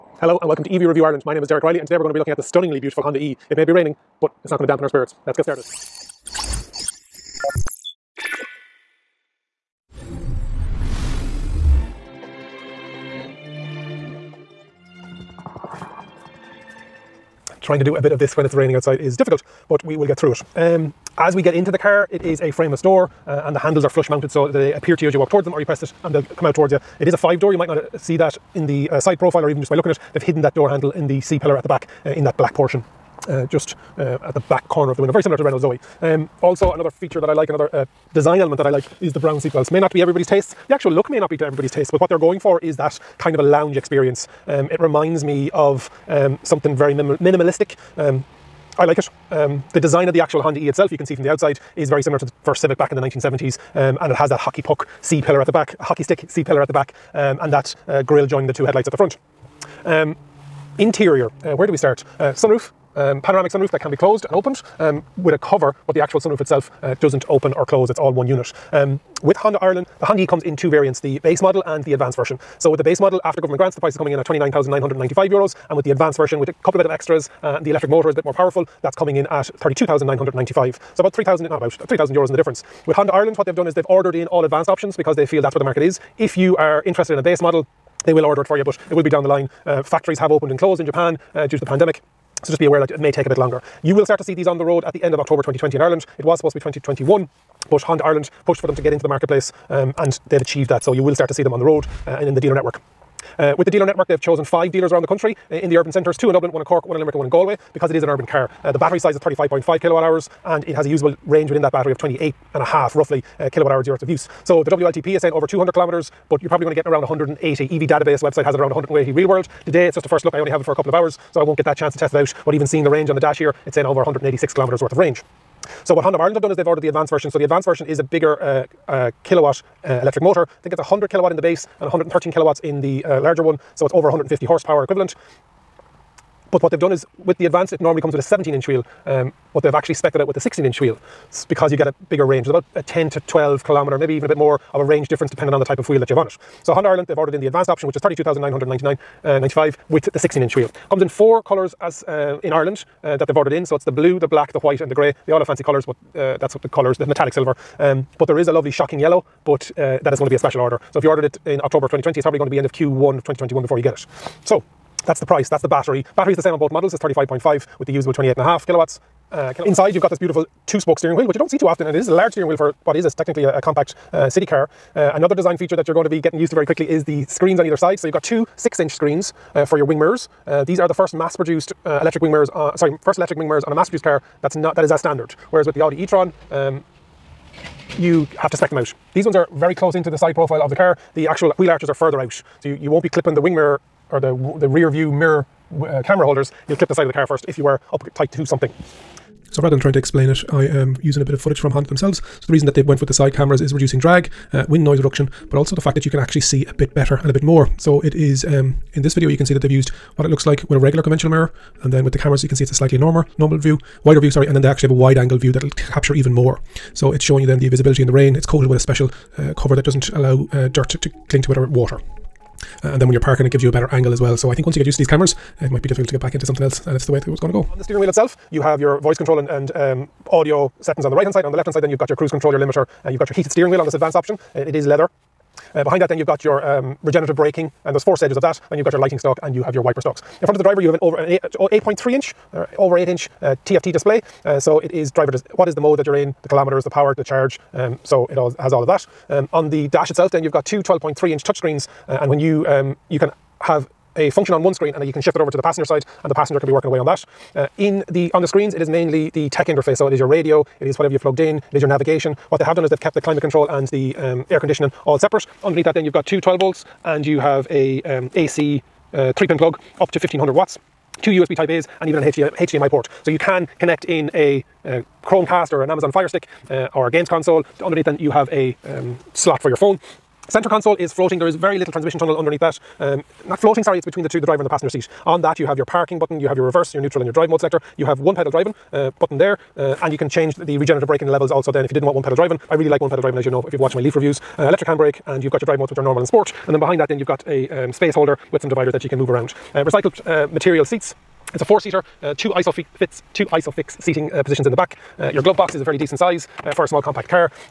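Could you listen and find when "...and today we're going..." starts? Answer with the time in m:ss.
0:01.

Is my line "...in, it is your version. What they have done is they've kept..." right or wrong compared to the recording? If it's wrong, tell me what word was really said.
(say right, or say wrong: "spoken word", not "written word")
wrong: "navigation", not "version".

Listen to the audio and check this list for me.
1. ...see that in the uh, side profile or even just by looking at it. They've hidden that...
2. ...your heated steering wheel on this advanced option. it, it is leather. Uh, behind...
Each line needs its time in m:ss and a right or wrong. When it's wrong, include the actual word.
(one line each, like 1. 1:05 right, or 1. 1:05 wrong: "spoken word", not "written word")
1. 0:27 right
2. 3:53 right.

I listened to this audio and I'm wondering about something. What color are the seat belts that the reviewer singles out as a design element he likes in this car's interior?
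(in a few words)
brown.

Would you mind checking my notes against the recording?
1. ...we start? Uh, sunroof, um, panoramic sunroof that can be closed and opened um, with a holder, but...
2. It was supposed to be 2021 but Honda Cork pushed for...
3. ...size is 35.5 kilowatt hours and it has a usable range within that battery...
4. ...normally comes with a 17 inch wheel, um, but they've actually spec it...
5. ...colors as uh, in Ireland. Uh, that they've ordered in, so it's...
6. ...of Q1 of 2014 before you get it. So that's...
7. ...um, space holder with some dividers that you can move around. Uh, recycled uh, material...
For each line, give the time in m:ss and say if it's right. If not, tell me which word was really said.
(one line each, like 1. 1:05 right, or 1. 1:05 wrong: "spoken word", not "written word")
1. 1:01 wrong: "cover", not "holder"
2. 1:36 wrong: "Ireland", not "Cork"
3. 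1:48 right
4. 2:17 right
5. 2:31 right
6. 2:42 wrong: "2021", not "2014"
7. 4:57 right.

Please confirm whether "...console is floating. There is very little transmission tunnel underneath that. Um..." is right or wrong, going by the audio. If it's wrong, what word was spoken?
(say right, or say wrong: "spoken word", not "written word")
right.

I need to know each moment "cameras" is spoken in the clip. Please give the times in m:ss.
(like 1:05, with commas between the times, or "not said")
3:16, 3:23, 3:32, 3:45.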